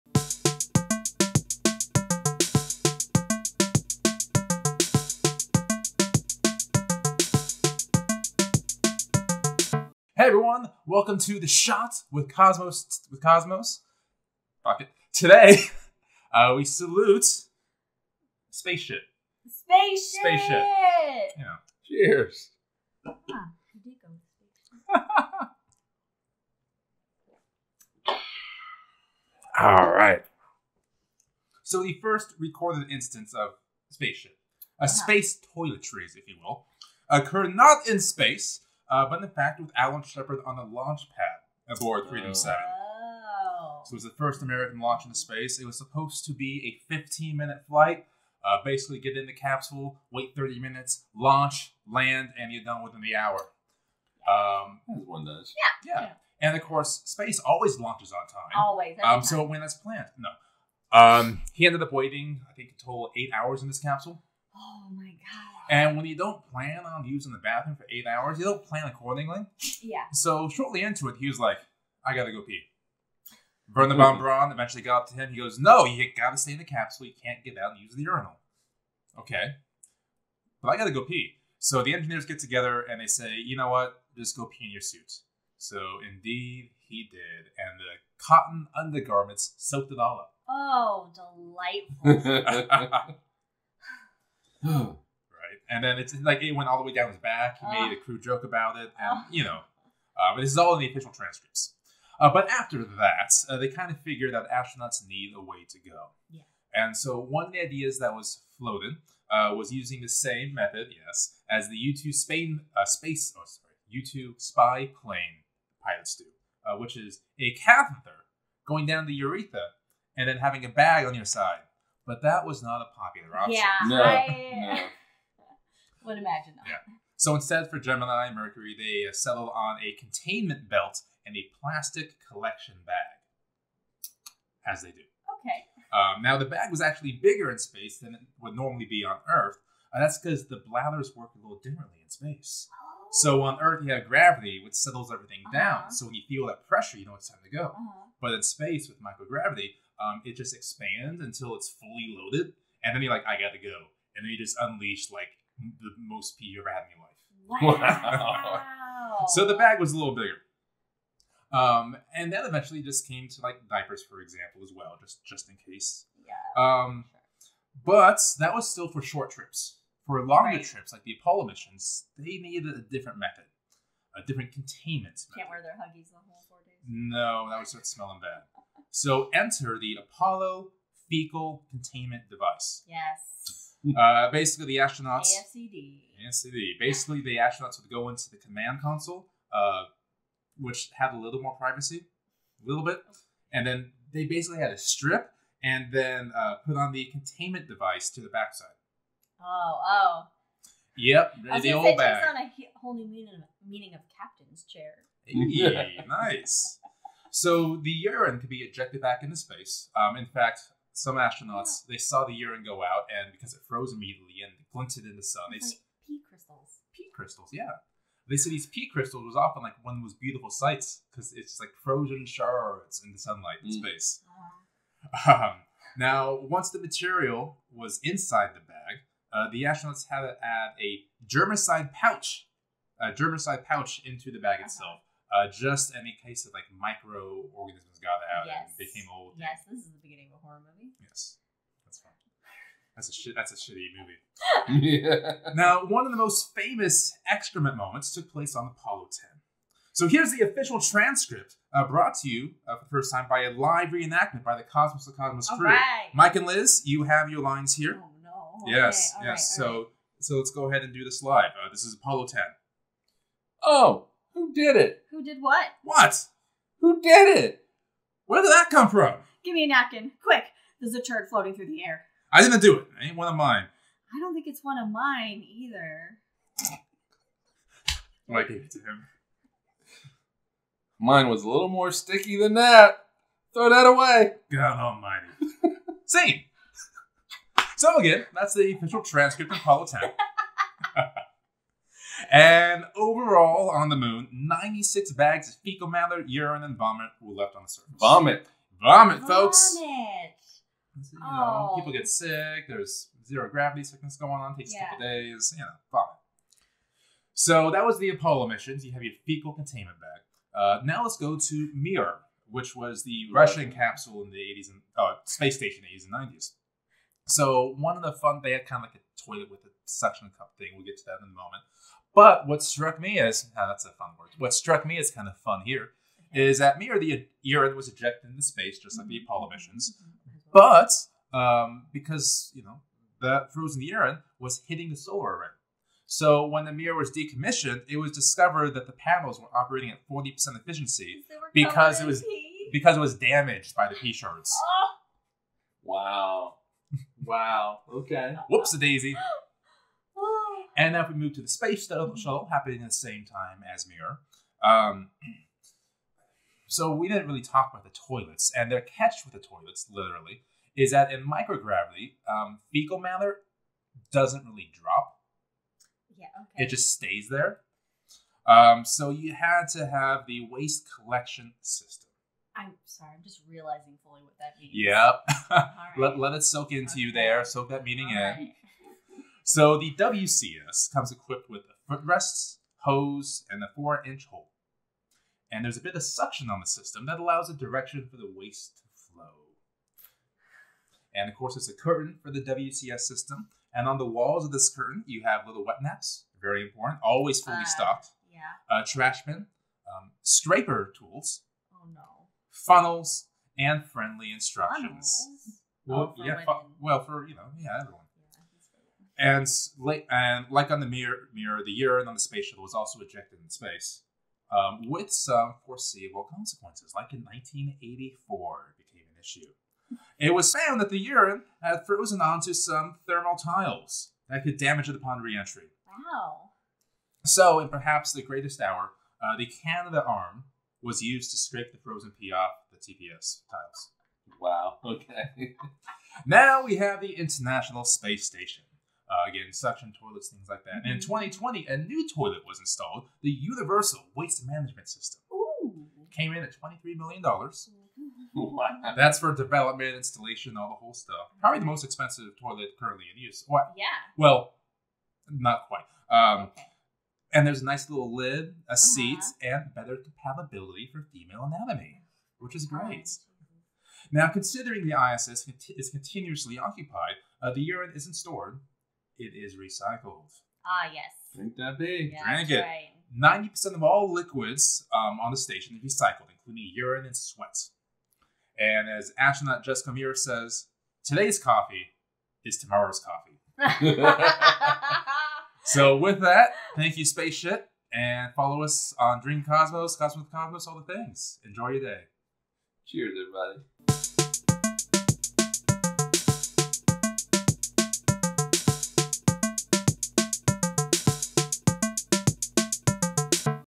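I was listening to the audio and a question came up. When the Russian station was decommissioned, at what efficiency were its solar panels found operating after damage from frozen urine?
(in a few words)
40%.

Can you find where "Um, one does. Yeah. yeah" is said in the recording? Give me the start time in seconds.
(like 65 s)
54 s.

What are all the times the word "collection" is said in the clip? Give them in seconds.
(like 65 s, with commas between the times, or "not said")
132 s, 370 s.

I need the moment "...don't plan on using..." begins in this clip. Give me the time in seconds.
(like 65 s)
66 s.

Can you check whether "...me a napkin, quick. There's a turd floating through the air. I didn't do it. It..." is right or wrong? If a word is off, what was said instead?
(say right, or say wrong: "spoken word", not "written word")
right.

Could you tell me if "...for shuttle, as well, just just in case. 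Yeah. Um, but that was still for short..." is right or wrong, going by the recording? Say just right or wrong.
wrong.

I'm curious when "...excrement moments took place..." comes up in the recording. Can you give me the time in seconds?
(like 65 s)
247 s.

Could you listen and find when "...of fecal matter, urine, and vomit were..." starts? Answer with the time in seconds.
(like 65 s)
295 s.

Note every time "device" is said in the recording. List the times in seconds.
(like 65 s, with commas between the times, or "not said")
182 s, 197 s.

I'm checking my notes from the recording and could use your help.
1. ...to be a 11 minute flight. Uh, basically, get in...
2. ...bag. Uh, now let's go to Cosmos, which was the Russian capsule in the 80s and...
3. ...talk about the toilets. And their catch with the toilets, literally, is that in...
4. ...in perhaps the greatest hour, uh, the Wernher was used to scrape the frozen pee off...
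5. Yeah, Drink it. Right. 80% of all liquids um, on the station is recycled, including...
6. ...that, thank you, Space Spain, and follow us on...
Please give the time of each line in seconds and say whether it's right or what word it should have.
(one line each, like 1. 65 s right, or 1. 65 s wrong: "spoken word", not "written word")
1. 46 s wrong: "15", not "11"
2. 309 s wrong: "Mir", not "Cosmos"
3. 357 s right
4. 427 s wrong: "Canadarm", not "Wernher"
5. 472 s wrong: "90", not "80"
6. 486 s wrong: "Shit", not "Spain".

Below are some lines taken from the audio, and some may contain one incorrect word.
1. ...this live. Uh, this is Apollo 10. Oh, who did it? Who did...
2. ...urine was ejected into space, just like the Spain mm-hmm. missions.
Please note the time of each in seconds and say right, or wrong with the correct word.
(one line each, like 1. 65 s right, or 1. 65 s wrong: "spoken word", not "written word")
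1. 261 s right
2. 327 s wrong: "Apollo", not "Spain".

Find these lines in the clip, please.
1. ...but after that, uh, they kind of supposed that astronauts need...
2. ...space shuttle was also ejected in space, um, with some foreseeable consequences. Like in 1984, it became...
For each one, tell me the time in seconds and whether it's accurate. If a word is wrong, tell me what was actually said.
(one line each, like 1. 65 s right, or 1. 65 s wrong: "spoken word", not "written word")
1. 102 s wrong: "figured", not "supposed"
2. 412 s right.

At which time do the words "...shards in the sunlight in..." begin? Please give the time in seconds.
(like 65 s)
222 s.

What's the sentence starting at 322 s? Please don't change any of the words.
But what struck me as uh, that's a fun word.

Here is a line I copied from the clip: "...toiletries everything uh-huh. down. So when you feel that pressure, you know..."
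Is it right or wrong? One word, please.
wrong.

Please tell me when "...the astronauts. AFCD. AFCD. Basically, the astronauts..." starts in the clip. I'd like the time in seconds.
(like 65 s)
184 s.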